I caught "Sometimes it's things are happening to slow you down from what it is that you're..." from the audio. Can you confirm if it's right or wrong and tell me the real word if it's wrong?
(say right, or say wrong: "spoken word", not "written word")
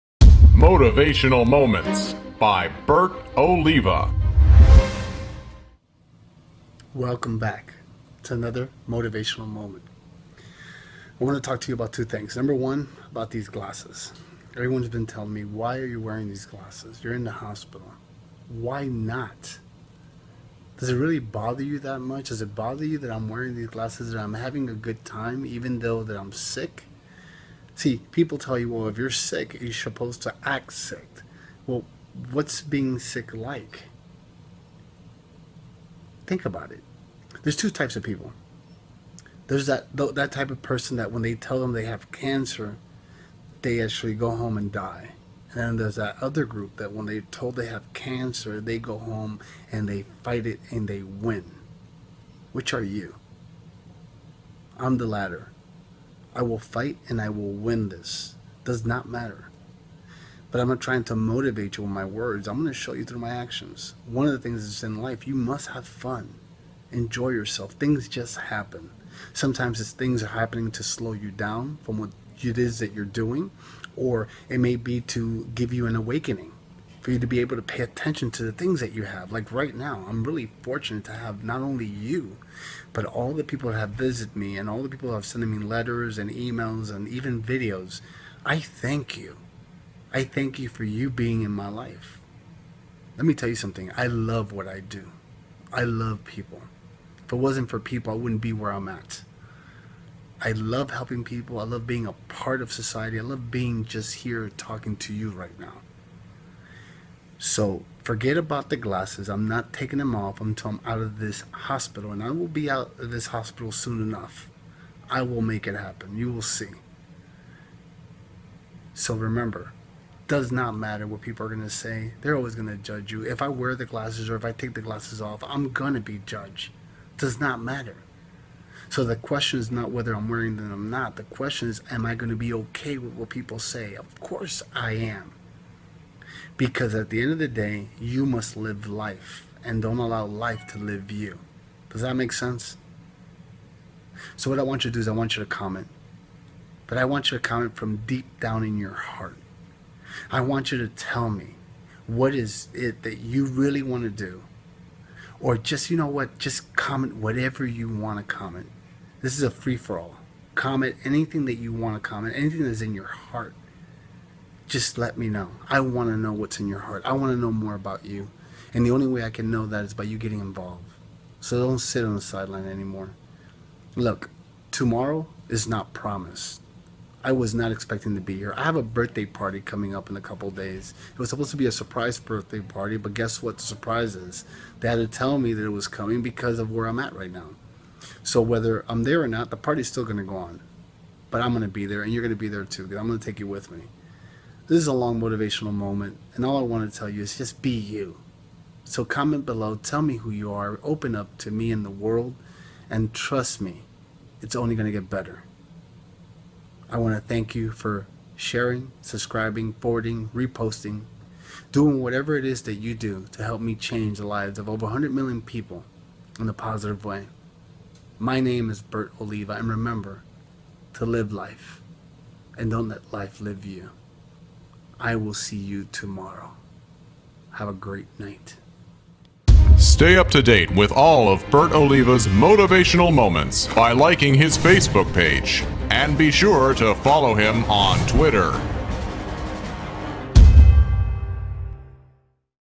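right.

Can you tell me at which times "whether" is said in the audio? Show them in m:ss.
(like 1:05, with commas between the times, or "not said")
2:09, 3:08.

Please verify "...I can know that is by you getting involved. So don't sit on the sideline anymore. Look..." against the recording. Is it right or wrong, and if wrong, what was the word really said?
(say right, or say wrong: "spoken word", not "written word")
right.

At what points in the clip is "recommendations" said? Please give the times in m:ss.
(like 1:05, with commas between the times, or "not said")
not said.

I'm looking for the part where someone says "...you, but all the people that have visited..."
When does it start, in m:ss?
1:21.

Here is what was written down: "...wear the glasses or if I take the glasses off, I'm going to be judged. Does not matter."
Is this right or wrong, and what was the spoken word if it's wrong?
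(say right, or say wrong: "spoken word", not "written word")
right.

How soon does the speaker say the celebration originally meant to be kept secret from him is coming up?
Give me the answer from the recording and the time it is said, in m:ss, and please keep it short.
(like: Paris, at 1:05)
a couple days, at 3:00.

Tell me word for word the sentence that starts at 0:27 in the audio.
See, people tell you, well, if you're sick, you're supposed to act sick.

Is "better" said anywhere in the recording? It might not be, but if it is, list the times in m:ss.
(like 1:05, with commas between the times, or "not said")
3:25.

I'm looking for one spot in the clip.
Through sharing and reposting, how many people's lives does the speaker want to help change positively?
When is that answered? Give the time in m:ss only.
3:34.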